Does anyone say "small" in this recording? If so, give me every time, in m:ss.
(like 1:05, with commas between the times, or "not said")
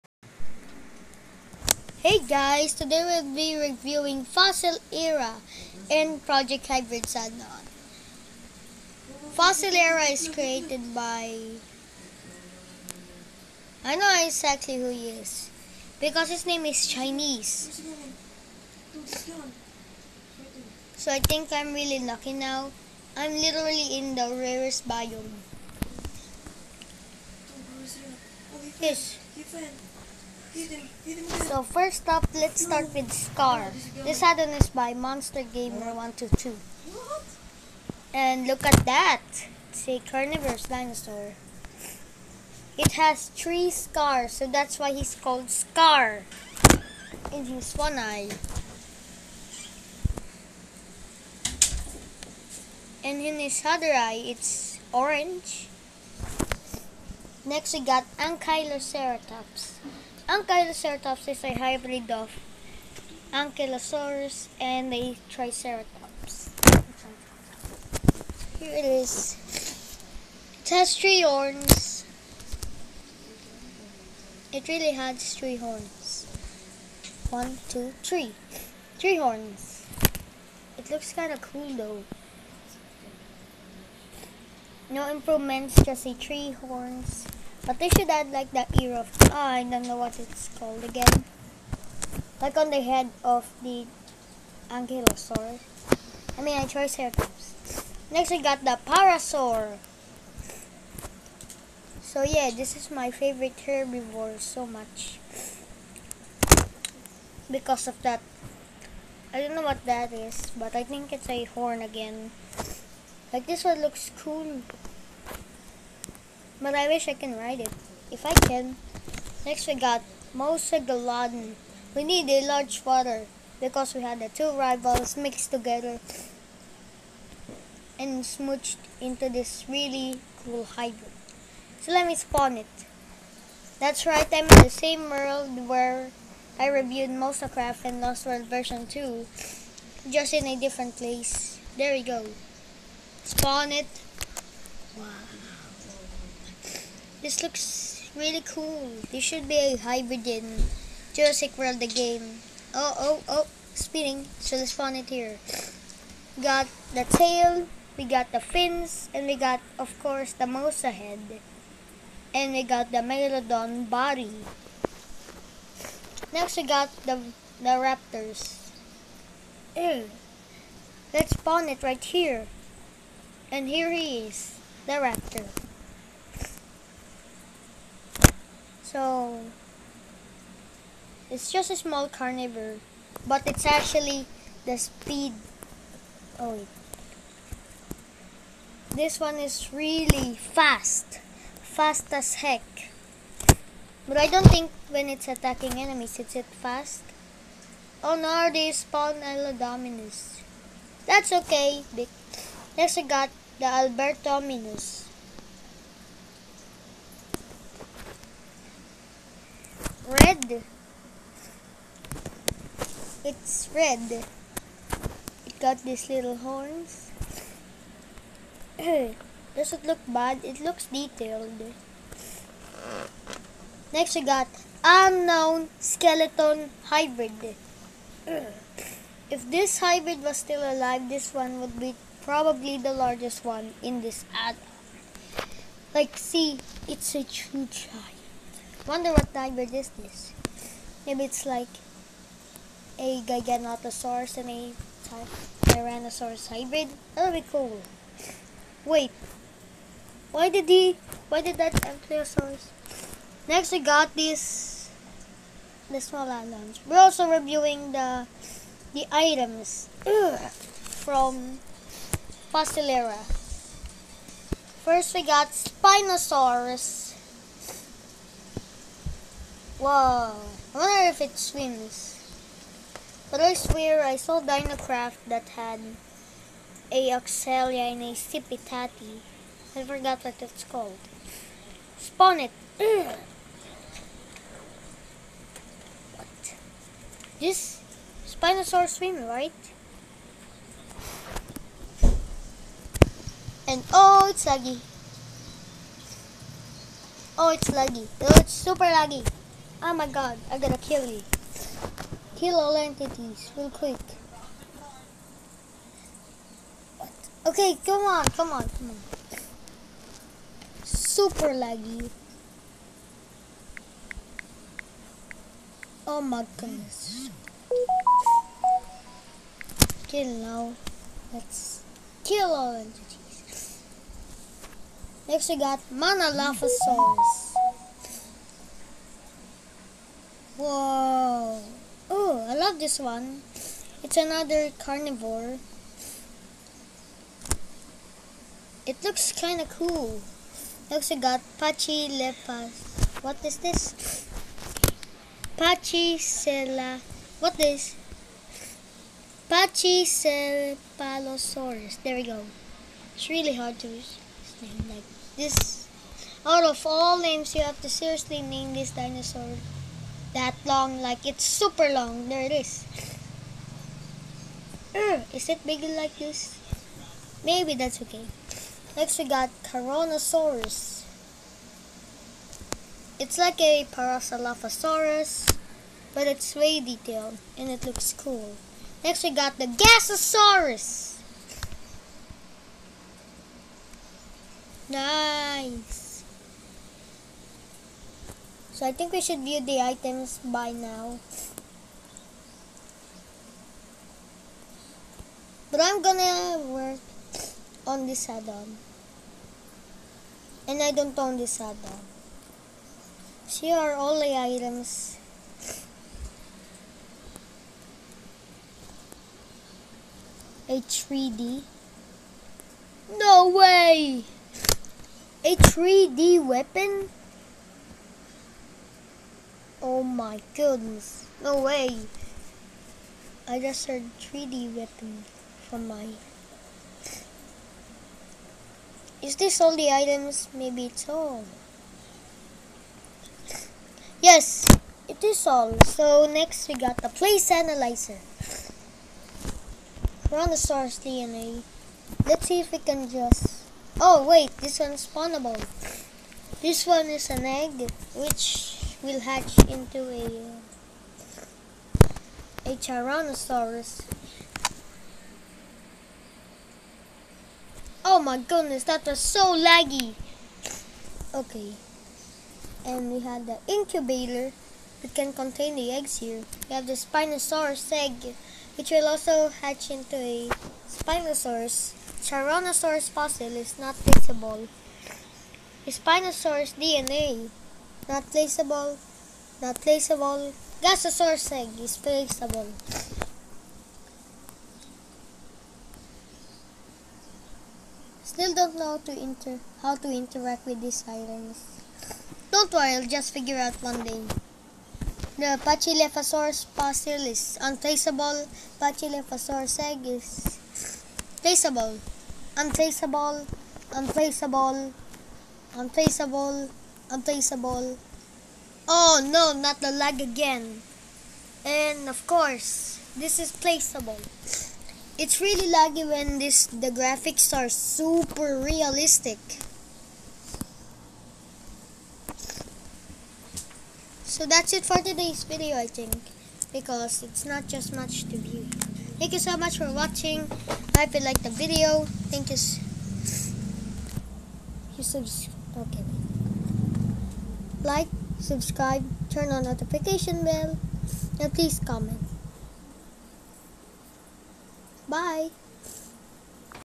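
3:01, 4:16.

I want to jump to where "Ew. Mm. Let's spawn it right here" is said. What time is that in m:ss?
2:49.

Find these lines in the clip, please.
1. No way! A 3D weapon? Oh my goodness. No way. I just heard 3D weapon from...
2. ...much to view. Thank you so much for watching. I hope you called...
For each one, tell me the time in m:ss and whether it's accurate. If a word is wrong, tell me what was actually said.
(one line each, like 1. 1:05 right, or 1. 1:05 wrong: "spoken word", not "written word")
1. 6:53 right
2. 8:47 wrong: "liked", not "called".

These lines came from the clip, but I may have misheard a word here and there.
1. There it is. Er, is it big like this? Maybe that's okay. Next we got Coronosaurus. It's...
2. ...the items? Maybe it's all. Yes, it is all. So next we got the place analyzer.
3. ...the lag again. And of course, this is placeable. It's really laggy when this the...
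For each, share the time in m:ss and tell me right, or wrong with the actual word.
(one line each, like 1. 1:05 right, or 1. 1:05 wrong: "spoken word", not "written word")
1. 6:02 right
2. 7:09 right
3. 8:29 right.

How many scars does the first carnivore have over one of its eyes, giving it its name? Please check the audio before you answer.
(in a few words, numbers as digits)
3.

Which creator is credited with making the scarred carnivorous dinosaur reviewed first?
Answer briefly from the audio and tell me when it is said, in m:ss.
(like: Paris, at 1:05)
Monster Gamer 122, at 0:34.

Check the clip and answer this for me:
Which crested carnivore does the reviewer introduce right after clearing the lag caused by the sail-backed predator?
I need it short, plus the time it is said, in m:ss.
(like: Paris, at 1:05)
Monolophosaurus, at 5:25.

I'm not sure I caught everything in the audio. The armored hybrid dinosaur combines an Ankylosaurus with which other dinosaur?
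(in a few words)
Triceratops.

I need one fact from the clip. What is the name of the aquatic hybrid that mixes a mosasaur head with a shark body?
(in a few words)
Mosaglodon.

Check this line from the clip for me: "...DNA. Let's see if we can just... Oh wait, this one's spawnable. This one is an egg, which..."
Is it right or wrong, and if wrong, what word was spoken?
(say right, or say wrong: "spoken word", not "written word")
right.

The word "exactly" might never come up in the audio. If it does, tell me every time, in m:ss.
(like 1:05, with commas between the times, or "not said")
0:14.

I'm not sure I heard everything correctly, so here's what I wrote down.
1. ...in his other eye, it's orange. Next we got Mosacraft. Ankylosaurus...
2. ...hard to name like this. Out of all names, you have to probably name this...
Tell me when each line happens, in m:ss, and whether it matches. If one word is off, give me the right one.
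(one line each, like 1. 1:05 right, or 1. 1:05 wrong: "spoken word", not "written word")
1. 0:53 wrong: "Ankyloceratops", not "Mosacraft"
2. 5:53 wrong: "seriously", not "probably".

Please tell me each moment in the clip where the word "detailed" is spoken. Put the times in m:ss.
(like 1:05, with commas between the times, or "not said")
3:40, 6:16.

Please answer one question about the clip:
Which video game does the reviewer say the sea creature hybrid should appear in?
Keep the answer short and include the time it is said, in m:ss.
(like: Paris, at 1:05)
Jurassic World, at 2:31.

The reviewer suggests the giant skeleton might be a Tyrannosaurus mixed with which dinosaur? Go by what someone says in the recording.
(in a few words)
Giganotosaurus.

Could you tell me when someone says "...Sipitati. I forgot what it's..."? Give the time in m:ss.
4:38.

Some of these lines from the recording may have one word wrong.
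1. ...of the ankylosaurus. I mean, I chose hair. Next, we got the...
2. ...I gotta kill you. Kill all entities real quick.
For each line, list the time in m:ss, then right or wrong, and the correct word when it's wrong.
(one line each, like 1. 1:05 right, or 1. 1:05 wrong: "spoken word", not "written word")
1. 1:33 right
2. 5:00 right.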